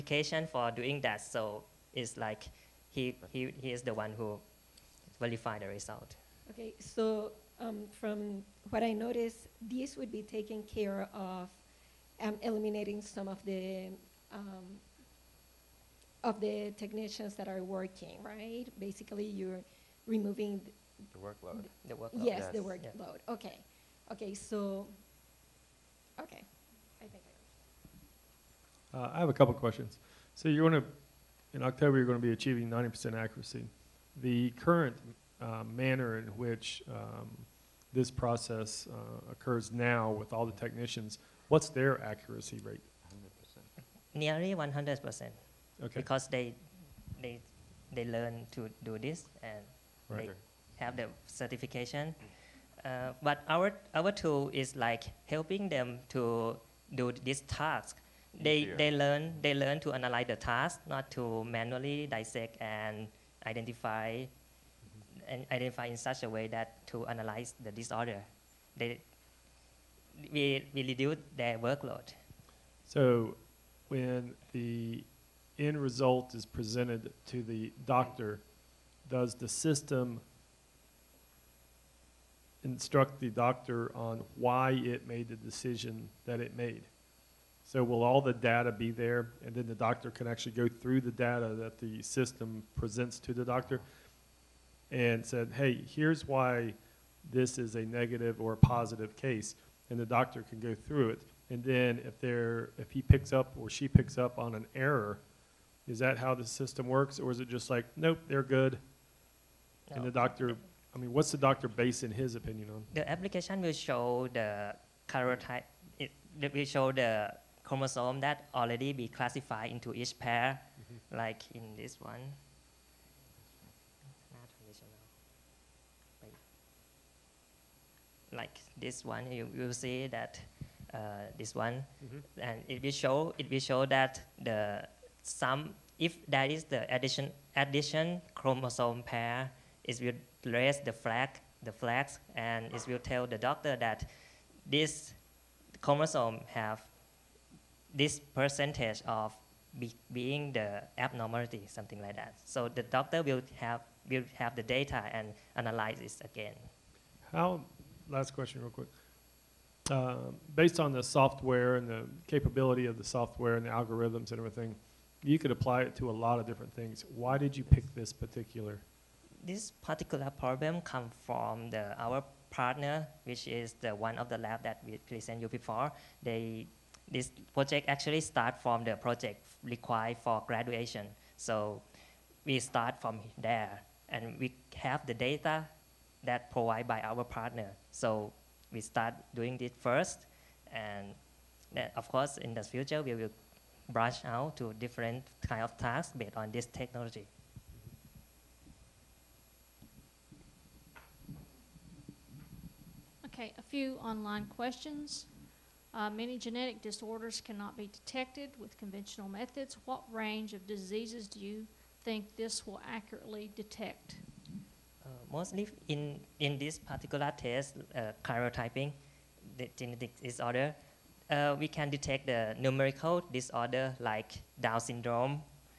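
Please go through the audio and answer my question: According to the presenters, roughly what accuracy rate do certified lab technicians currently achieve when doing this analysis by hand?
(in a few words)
Nearly 100%.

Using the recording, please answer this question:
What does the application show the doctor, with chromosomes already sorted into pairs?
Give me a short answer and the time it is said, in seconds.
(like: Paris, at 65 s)
karyotype, at 115 s.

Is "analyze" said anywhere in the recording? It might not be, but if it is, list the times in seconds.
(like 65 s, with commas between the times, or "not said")
59 s, 67 s, 155 s.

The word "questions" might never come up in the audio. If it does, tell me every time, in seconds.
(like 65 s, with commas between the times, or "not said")
29 s, 158 s, 204 s.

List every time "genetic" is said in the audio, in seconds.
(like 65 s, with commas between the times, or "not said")
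206 s, 219 s.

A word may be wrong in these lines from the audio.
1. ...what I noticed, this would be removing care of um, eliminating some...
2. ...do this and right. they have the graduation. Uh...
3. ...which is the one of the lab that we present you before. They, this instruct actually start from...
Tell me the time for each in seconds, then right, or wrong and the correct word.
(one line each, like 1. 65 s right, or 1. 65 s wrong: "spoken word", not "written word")
1. 8 s wrong: "taking", not "removing"
2. 48 s wrong: "certification", not "graduation"
3. 173 s wrong: "project", not "instruct".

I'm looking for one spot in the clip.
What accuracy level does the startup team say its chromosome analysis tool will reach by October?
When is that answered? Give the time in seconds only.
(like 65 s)
32 s.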